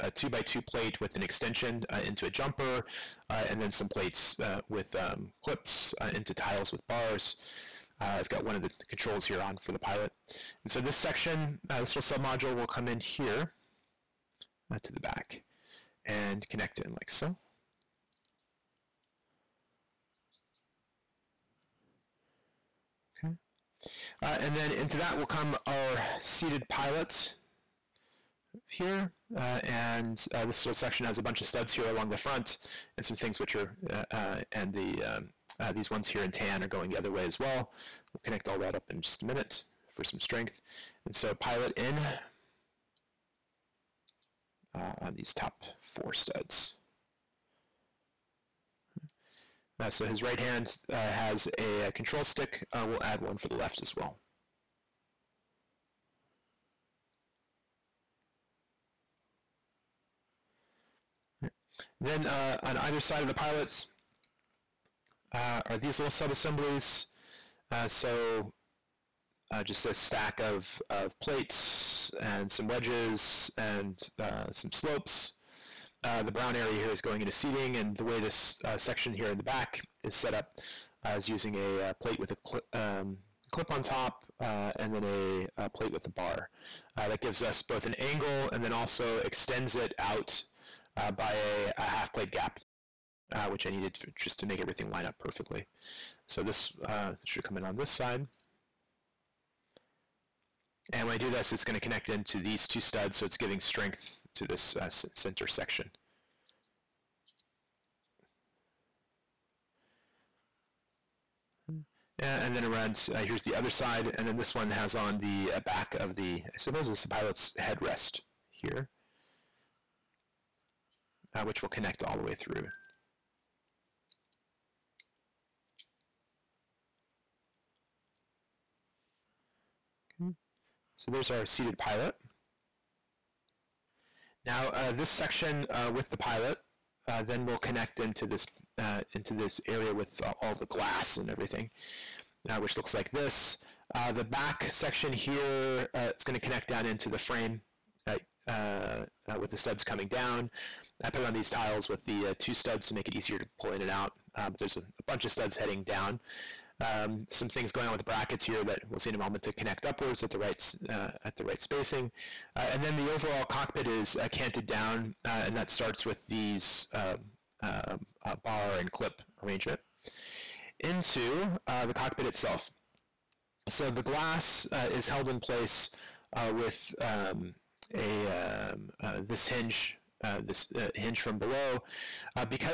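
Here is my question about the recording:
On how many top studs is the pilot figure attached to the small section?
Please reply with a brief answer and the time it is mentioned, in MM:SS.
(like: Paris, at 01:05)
4, at 00:45.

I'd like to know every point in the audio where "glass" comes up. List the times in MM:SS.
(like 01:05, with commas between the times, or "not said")
02:20, 02:54.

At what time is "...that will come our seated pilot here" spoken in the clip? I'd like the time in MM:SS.
00:24.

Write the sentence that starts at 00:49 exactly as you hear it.
so his right hand has a, control stick.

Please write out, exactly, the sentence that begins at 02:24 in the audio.
the back section here is going to connect down into the frame uh, uh, with the studs coming down.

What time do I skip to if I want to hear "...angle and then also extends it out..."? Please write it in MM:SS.
01:27.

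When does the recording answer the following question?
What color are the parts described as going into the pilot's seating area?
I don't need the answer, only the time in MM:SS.
01:16.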